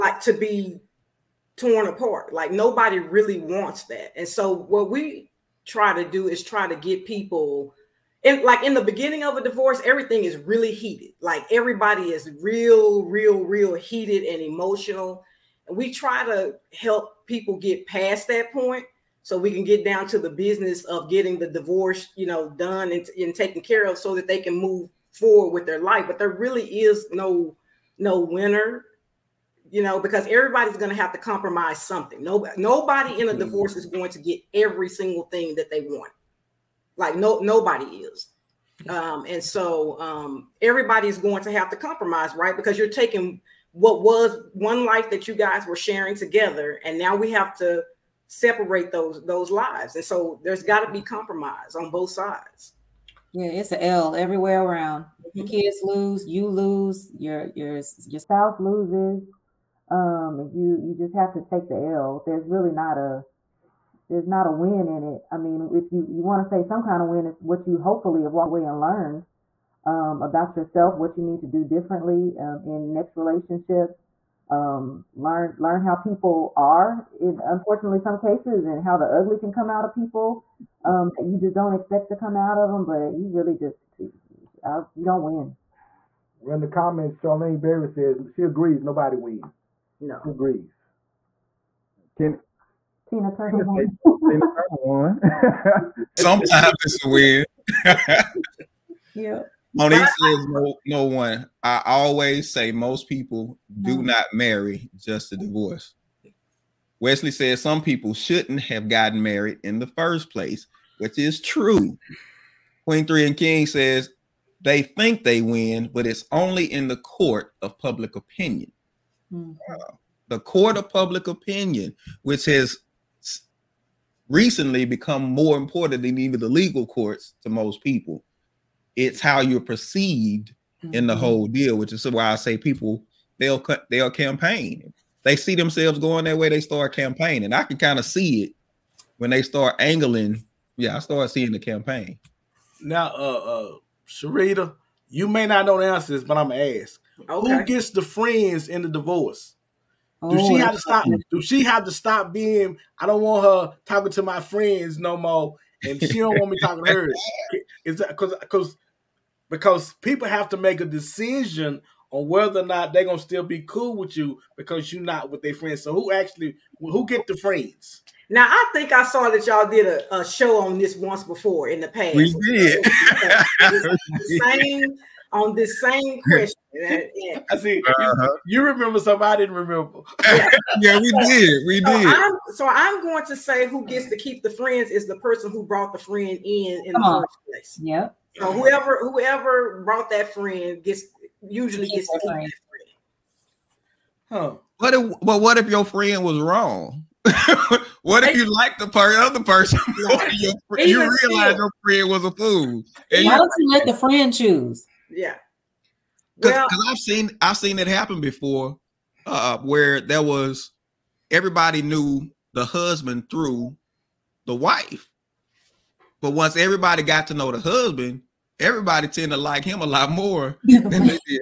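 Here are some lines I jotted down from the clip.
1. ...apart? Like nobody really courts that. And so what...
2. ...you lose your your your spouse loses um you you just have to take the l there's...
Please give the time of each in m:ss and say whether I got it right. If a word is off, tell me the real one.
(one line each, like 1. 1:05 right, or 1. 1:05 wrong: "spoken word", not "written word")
1. 0:01 wrong: "wants", not "courts"
2. 0:56 right.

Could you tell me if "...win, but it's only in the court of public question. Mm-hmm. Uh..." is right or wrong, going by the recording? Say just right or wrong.
wrong.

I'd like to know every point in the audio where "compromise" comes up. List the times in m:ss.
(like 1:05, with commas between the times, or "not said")
0:31, 0:41, 0:51.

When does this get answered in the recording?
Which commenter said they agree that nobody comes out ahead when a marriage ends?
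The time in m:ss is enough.
1:27.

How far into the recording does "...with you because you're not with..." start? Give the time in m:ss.
2:43.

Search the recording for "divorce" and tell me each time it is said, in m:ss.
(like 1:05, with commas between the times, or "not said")
0:09, 0:21, 0:33, 1:45, 2:28.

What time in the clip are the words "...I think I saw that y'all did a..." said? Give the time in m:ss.
2:48.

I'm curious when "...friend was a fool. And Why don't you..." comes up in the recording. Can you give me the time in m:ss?
3:21.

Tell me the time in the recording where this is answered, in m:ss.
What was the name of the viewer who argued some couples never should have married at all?
1:47.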